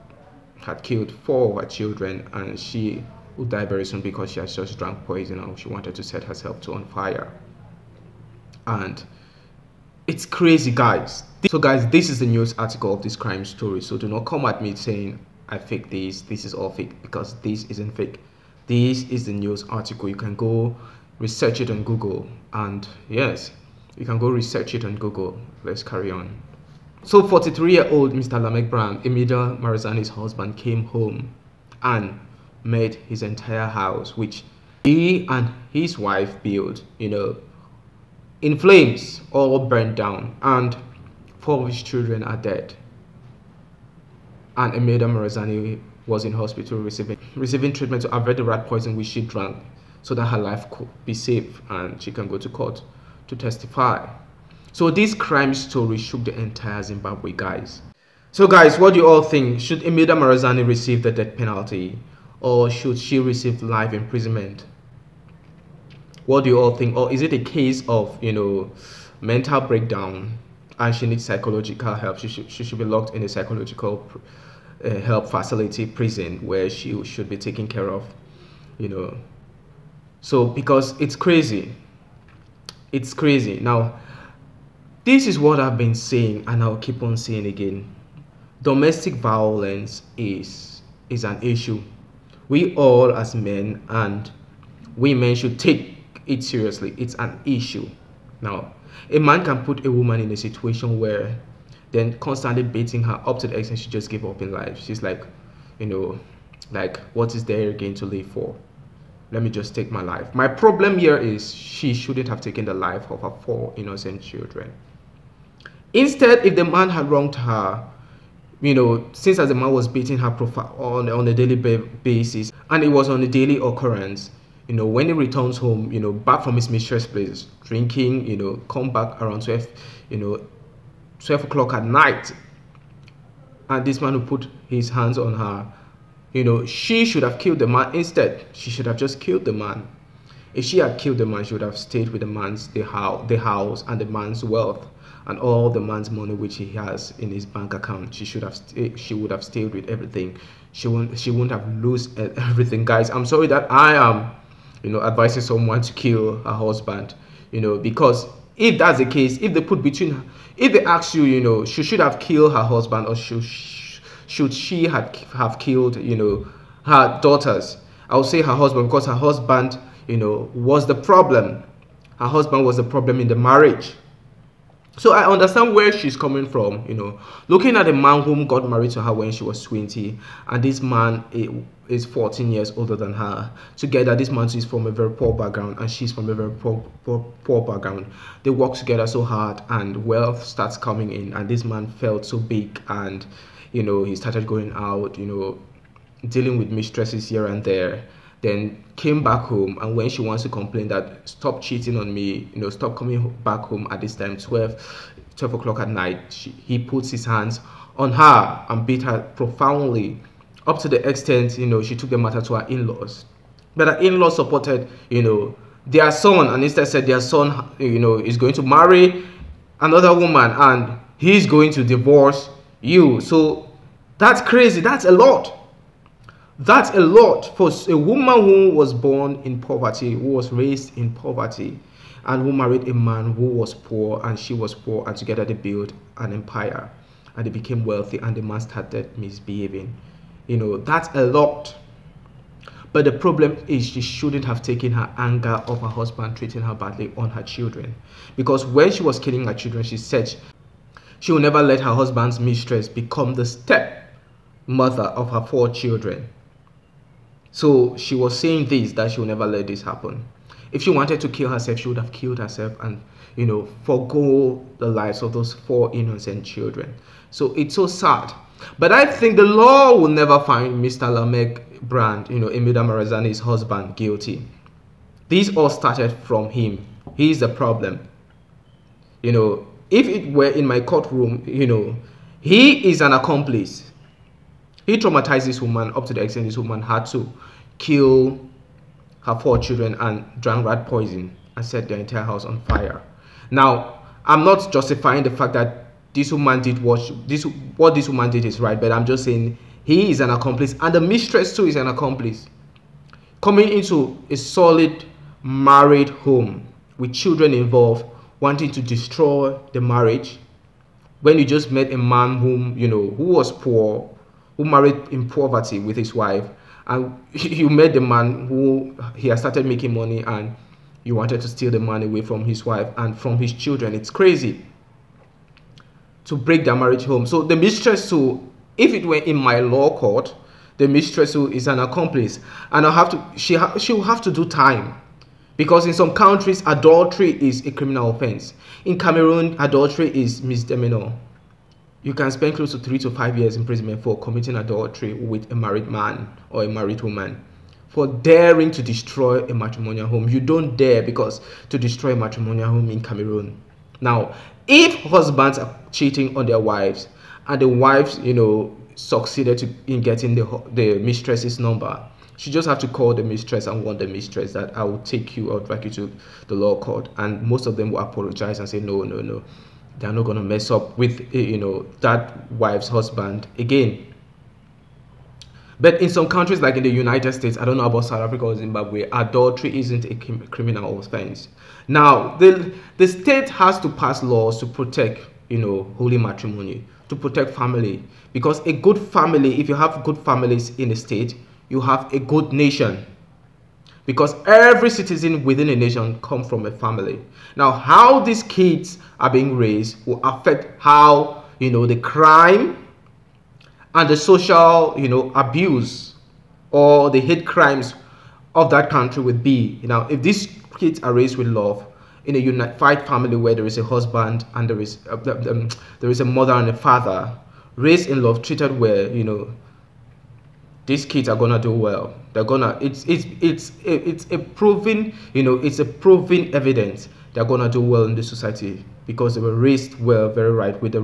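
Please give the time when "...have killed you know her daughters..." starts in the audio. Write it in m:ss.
2:45.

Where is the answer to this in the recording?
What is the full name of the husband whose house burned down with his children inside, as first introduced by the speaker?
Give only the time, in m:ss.
0:28.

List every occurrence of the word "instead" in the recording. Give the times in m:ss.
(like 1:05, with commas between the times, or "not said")
1:55, 2:17, 3:36.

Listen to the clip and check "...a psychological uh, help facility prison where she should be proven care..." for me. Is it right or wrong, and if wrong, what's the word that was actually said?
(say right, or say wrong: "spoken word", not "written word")
wrong: "taken", not "proven".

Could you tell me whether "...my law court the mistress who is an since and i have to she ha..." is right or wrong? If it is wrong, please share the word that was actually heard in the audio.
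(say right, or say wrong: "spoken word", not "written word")
wrong: "accomplice", not "since".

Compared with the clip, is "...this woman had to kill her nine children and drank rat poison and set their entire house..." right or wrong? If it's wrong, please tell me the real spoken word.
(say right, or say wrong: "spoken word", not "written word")
wrong: "four", not "nine".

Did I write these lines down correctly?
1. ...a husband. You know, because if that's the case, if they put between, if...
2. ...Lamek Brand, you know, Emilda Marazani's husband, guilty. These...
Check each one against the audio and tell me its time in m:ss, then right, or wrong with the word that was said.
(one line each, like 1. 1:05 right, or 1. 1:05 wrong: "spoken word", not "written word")
1. 2:36 right
2. 4:31 right.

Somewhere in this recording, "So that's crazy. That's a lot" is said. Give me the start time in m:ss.
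3:43.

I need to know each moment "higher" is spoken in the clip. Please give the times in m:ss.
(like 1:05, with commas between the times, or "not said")
not said.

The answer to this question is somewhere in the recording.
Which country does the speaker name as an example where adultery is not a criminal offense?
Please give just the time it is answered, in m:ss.
6:16.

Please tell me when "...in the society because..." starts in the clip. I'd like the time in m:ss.
7:08.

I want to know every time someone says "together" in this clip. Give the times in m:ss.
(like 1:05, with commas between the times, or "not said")
3:03, 3:08, 3:55.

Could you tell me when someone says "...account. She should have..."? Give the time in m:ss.
2:27.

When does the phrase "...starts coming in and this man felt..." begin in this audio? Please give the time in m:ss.
3:10.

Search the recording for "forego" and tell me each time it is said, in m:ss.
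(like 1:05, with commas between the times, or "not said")
4:23.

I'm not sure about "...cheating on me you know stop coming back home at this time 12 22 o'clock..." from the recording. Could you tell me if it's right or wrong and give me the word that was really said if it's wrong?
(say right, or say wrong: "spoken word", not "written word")
wrong: "12", not "22".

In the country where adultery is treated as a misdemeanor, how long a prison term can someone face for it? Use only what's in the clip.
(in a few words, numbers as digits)
3 to 5 years.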